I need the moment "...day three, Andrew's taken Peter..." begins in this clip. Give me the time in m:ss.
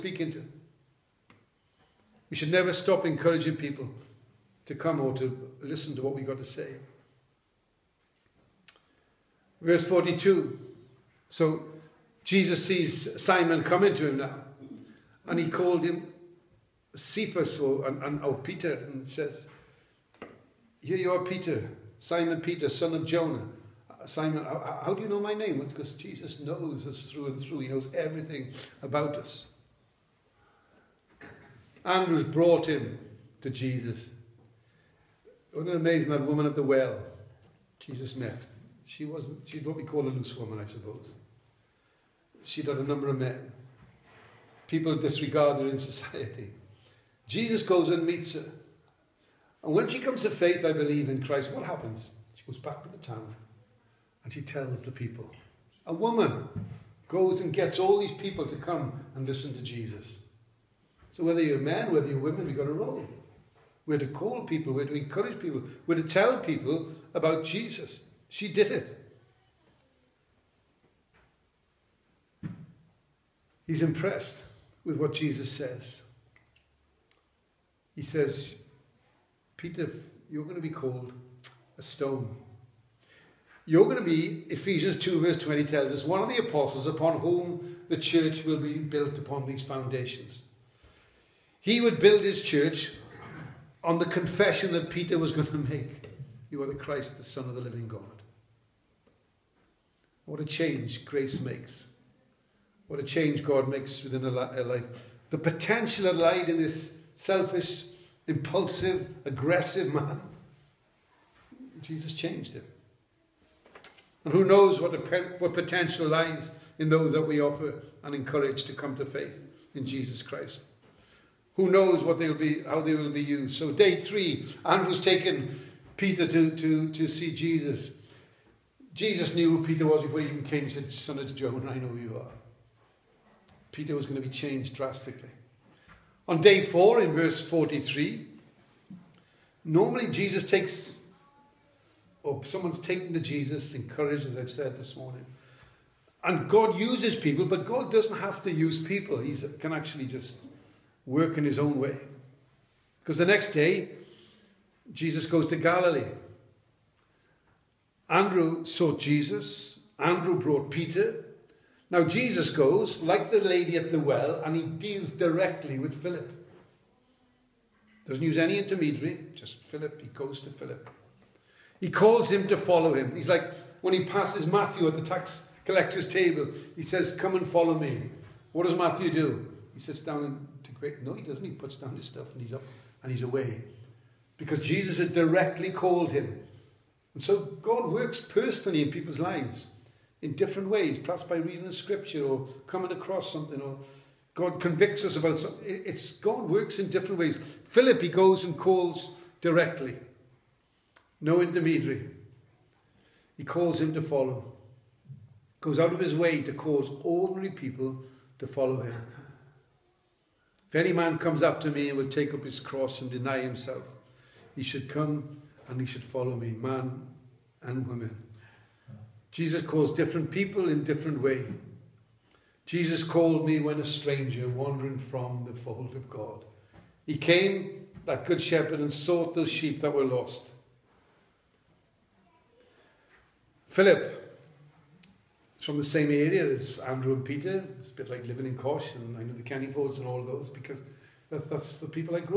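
2:03.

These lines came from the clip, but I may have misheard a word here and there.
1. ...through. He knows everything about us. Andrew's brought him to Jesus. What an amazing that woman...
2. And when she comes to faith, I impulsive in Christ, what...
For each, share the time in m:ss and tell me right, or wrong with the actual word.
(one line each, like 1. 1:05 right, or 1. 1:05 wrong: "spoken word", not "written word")
1. 0:27 right
2. 0:49 wrong: "believe", not "impulsive".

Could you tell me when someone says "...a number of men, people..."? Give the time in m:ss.
0:42.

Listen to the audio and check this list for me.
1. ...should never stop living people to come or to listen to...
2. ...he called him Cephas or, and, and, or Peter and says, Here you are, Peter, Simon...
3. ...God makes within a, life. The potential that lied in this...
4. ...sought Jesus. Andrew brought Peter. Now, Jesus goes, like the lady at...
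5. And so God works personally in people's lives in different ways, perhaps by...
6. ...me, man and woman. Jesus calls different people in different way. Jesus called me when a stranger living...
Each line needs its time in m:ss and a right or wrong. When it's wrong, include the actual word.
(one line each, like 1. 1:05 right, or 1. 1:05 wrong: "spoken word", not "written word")
1. 0:02 wrong: "encouraging", not "living"
2. 0:15 right
3. 1:43 right
4. 2:38 right
5. 3:07 right
6. 3:36 wrong: "wandering", not "living".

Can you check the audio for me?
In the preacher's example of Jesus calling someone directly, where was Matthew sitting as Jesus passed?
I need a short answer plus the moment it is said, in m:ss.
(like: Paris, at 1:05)
tax collector's table, at 2:55.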